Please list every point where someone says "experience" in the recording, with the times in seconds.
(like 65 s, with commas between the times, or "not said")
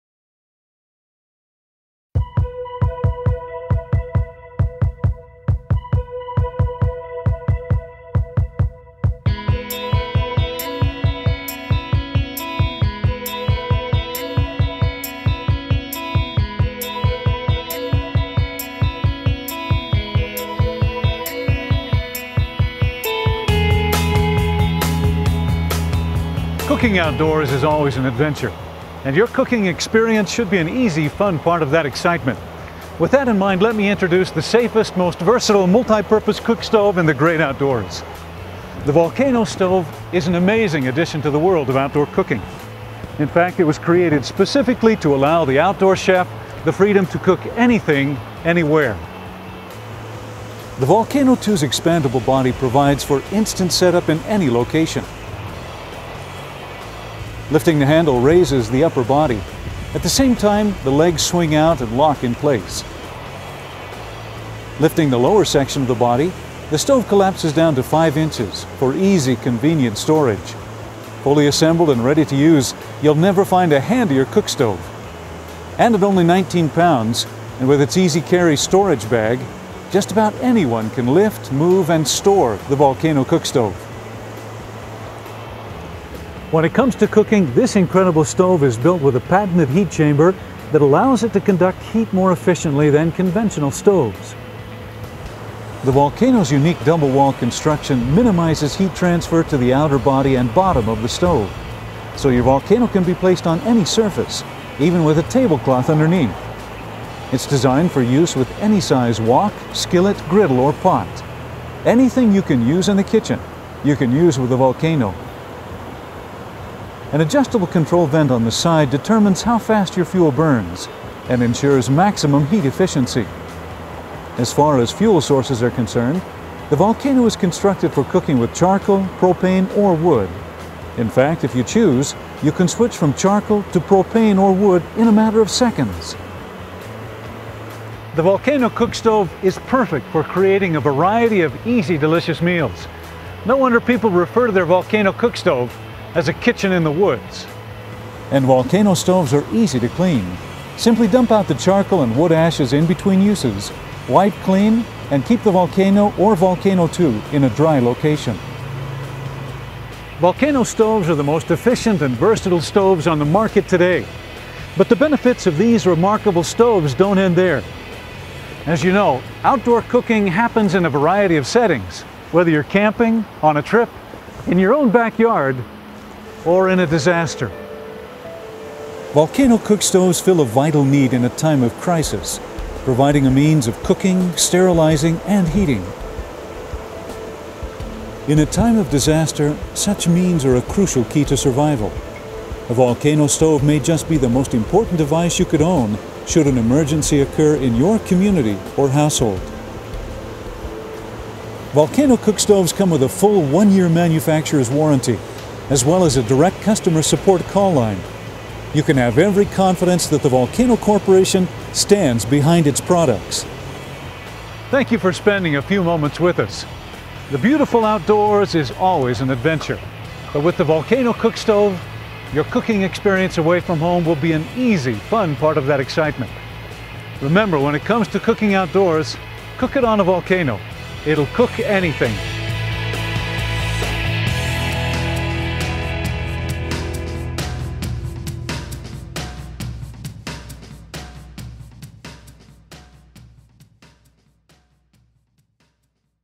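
29 s, 222 s.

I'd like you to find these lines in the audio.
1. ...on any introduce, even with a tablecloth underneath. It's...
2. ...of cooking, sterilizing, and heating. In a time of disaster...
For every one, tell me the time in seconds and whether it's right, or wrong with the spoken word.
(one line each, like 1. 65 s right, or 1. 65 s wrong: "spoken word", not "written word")
1. 103 s wrong: "surface", not "introduce"
2. 183 s right.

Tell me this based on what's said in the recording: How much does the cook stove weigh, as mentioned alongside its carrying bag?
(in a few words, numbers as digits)
19 pounds.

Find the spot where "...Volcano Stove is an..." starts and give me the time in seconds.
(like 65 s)
38 s.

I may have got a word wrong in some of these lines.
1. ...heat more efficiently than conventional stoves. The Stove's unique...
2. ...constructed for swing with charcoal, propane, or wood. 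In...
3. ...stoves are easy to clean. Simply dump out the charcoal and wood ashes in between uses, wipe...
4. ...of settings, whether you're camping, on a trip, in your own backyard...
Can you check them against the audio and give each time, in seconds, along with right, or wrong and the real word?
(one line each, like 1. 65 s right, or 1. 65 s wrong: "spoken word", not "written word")
1. 91 s wrong: "Volcano", not "Stove"
2. 127 s wrong: "cooking", not "swing"
3. 148 s right
4. 171 s right.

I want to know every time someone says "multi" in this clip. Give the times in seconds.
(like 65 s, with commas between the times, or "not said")
35 s.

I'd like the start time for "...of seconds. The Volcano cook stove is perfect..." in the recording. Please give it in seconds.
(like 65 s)
135 s.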